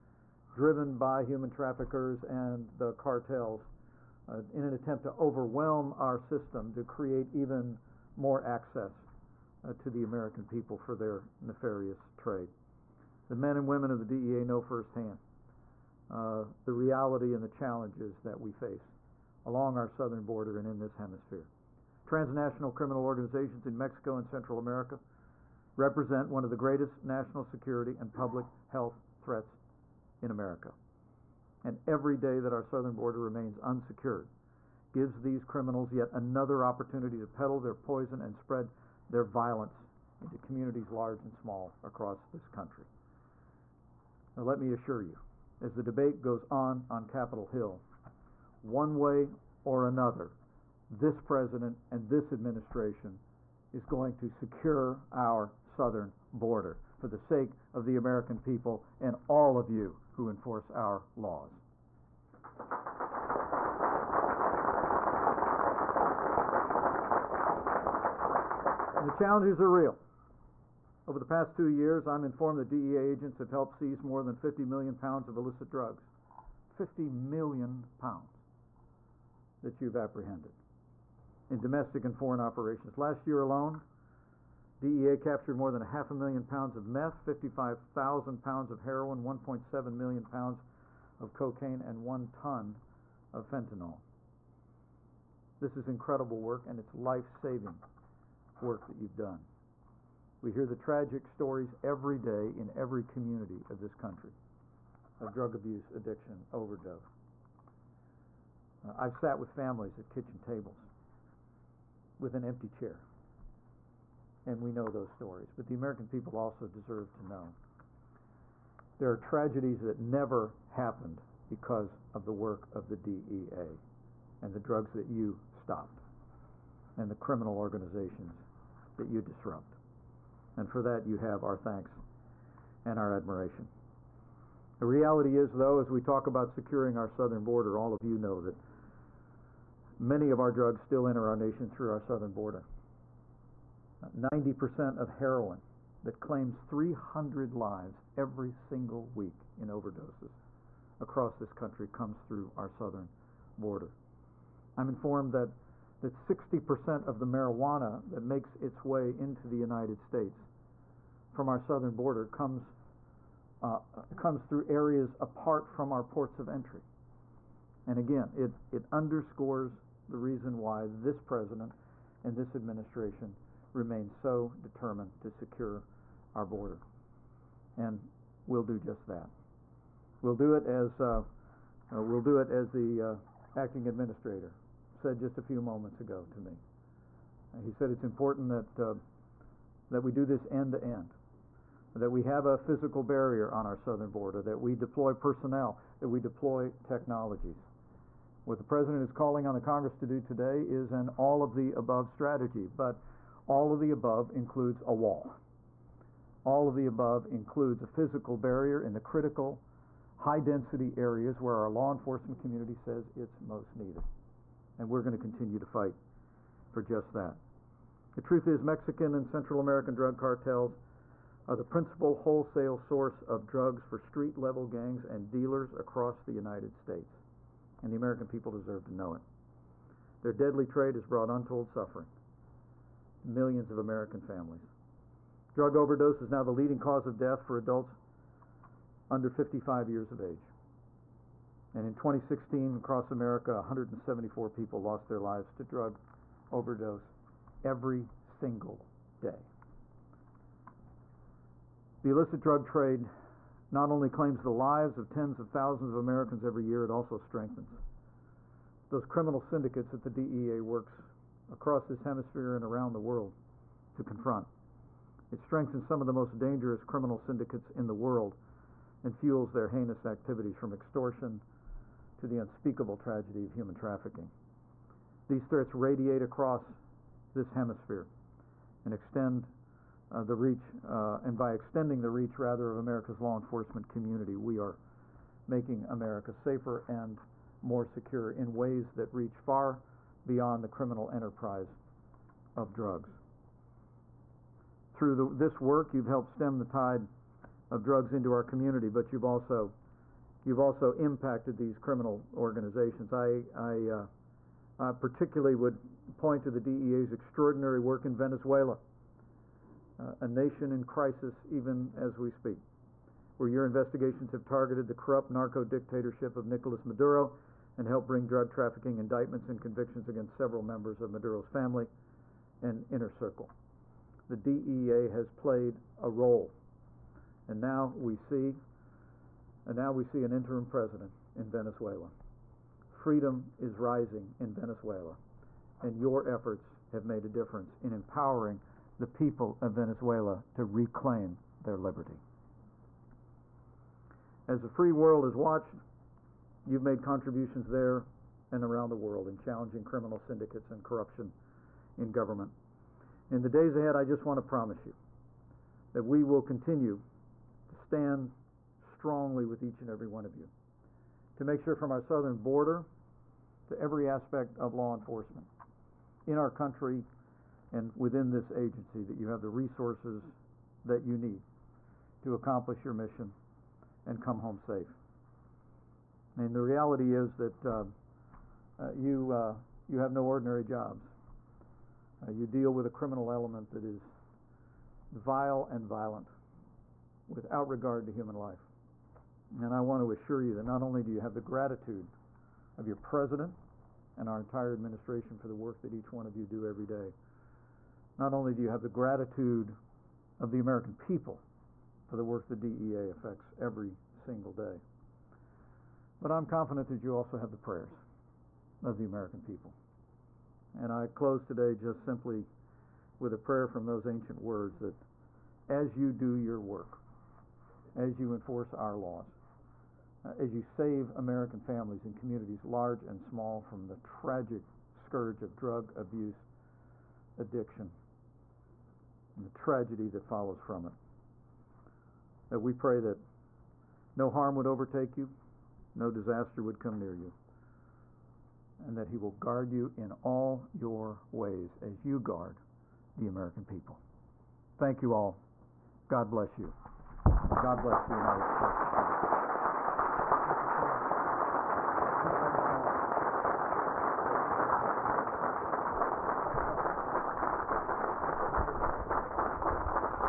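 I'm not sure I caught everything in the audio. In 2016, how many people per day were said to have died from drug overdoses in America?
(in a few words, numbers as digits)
174.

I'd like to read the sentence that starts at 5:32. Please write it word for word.
Freedom is rising in Venezuela, and your efforts have made a difference in empowering the people of Venezuela to reclaim their liberty.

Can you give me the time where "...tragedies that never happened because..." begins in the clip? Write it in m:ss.
1:59.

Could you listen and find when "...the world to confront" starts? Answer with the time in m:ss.
4:22.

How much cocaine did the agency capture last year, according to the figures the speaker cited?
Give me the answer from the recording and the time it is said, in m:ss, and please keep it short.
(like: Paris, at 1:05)
1.7 million pounds, at 1:29.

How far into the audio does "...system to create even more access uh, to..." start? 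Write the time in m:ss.
0:06.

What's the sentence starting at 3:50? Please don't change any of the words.
Their deadly trade has brought untold suffering to millions of American families.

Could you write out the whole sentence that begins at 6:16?
I mean, the reality is that uh, uh, you, uh, you have no ordinary jobs.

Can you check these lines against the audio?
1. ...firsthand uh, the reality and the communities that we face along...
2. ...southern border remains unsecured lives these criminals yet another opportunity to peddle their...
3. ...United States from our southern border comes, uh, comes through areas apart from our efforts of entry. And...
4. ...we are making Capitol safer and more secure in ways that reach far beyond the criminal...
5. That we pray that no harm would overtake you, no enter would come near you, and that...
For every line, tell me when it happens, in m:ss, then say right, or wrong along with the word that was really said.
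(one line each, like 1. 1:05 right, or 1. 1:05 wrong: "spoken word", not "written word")
1. 0:14 wrong: "challenges", not "communities"
2. 0:32 wrong: "gives", not "lives"
3. 2:39 wrong: "ports", not "efforts"
4. 4:44 wrong: "America", not "Capitol"
5. 7:12 wrong: "disaster", not "enter".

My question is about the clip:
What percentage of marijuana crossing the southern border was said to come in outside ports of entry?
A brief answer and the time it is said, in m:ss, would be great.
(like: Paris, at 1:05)
60%, at 2:36.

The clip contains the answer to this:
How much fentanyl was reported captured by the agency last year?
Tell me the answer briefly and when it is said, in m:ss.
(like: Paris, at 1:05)
one ton, at 1:32.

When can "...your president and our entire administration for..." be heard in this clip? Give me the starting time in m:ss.
6:32.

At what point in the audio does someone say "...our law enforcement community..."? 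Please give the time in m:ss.
3:31.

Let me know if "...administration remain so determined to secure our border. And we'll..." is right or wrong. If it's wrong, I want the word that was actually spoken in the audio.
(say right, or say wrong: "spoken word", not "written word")
right.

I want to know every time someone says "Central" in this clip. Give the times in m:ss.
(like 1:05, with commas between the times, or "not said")
0:24, 3:39.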